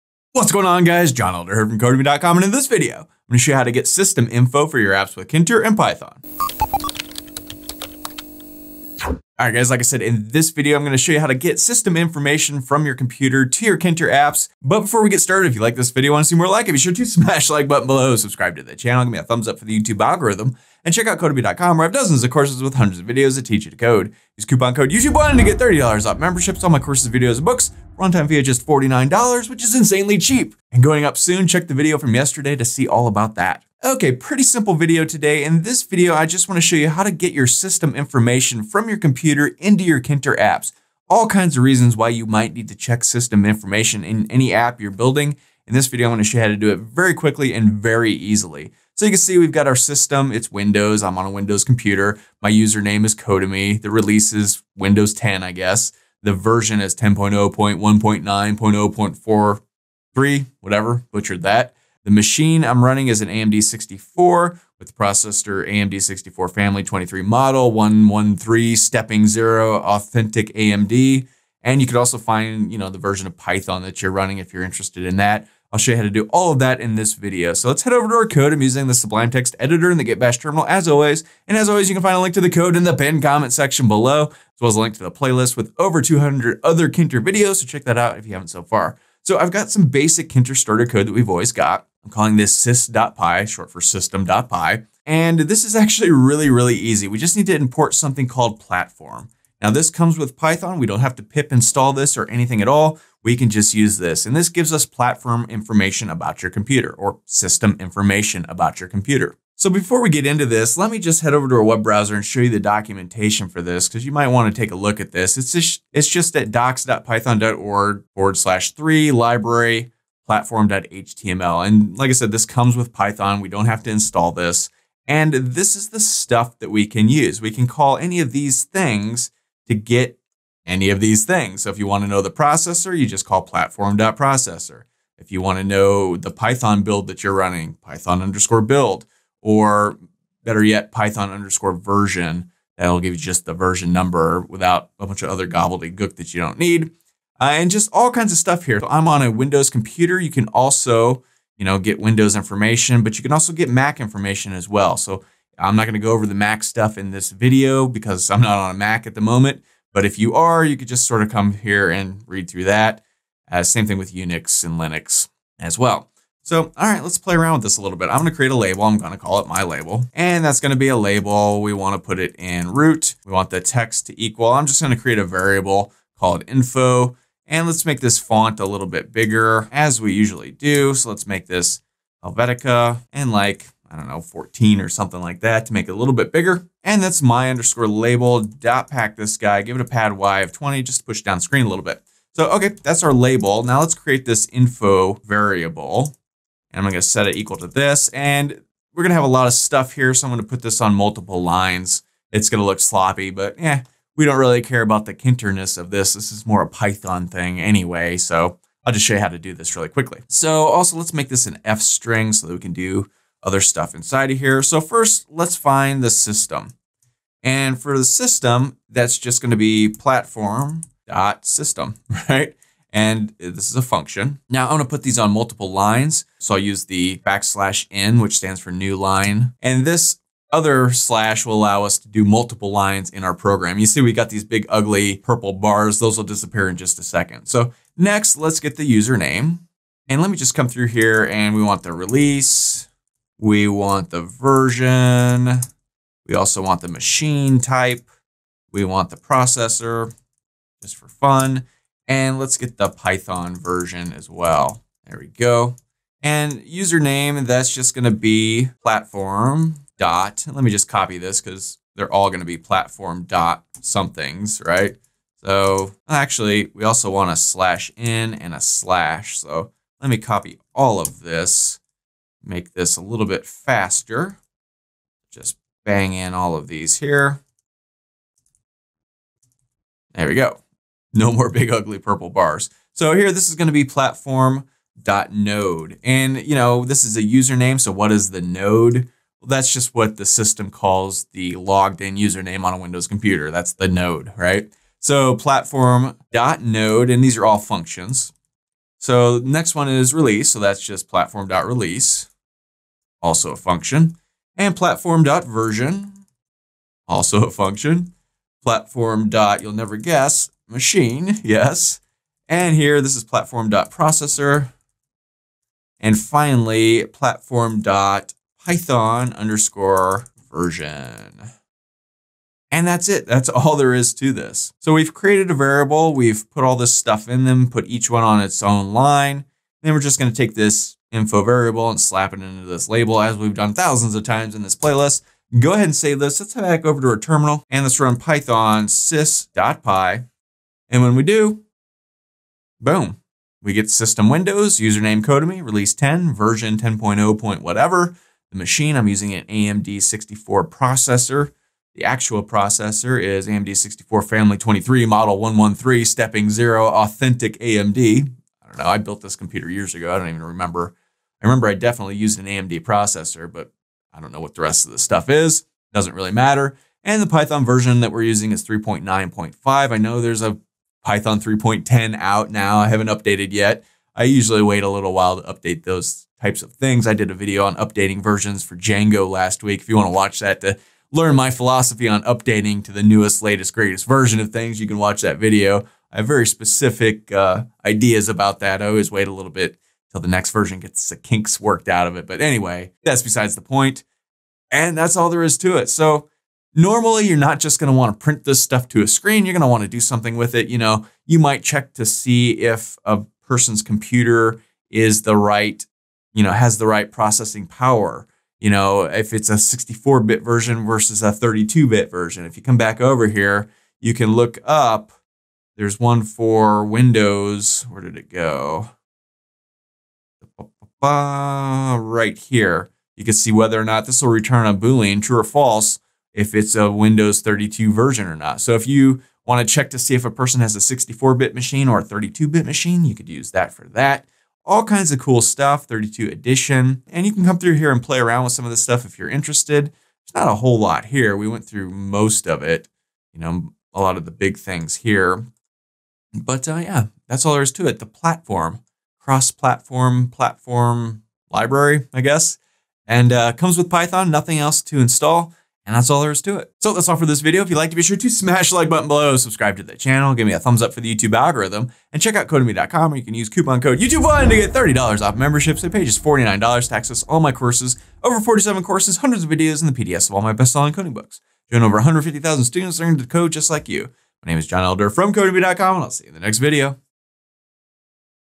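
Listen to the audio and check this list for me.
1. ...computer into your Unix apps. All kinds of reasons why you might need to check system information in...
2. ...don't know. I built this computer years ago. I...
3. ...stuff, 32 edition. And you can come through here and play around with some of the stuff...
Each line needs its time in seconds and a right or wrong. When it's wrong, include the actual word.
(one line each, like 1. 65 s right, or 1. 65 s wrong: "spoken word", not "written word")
1. 38 s wrong: "Tkinter", not "Unix"
2. 358 s right
3. 435 s right.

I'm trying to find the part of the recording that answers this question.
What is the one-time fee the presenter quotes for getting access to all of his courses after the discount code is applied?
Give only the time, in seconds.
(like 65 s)
27 s.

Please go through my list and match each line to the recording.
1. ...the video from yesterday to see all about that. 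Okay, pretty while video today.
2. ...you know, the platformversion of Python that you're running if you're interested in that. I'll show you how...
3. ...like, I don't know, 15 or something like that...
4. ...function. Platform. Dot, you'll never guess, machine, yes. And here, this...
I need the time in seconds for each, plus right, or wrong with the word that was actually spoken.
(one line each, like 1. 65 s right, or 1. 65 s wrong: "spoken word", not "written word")
1. 31 s wrong: "simple", not "while"
2. 72 s wrong: "version", not "platformversion"
3. 183 s wrong: "14", not "15"
4. 307 s right.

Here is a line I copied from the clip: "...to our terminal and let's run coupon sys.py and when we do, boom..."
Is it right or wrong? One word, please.
wrong.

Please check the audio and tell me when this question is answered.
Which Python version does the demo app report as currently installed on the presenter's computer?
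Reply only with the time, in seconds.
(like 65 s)
368 s.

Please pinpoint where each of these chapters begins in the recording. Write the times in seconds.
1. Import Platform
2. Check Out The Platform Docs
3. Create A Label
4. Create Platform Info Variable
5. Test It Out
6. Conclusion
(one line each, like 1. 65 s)
1. 97 s
2. 112 s
3. 166 s
4. 194 s
5. 336 s
6. 395 s.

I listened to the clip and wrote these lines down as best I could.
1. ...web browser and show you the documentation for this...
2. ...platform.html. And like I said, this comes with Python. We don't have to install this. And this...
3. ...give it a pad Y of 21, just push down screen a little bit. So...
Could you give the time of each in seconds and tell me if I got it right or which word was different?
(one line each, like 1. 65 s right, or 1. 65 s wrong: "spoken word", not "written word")
1. 111 s right
2. 120 s right
3. 189 s wrong: "20", not "21".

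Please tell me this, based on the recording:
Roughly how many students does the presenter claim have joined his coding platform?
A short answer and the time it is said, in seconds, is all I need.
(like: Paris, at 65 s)
150,000, at 471 s.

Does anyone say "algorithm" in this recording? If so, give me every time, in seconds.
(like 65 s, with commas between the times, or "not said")
19 s, 461 s.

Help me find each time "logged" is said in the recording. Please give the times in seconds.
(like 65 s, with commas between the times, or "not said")
291 s.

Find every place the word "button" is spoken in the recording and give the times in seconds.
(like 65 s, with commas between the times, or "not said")
17 s, 458 s.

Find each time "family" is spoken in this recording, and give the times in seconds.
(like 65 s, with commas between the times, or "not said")
66 s, 354 s.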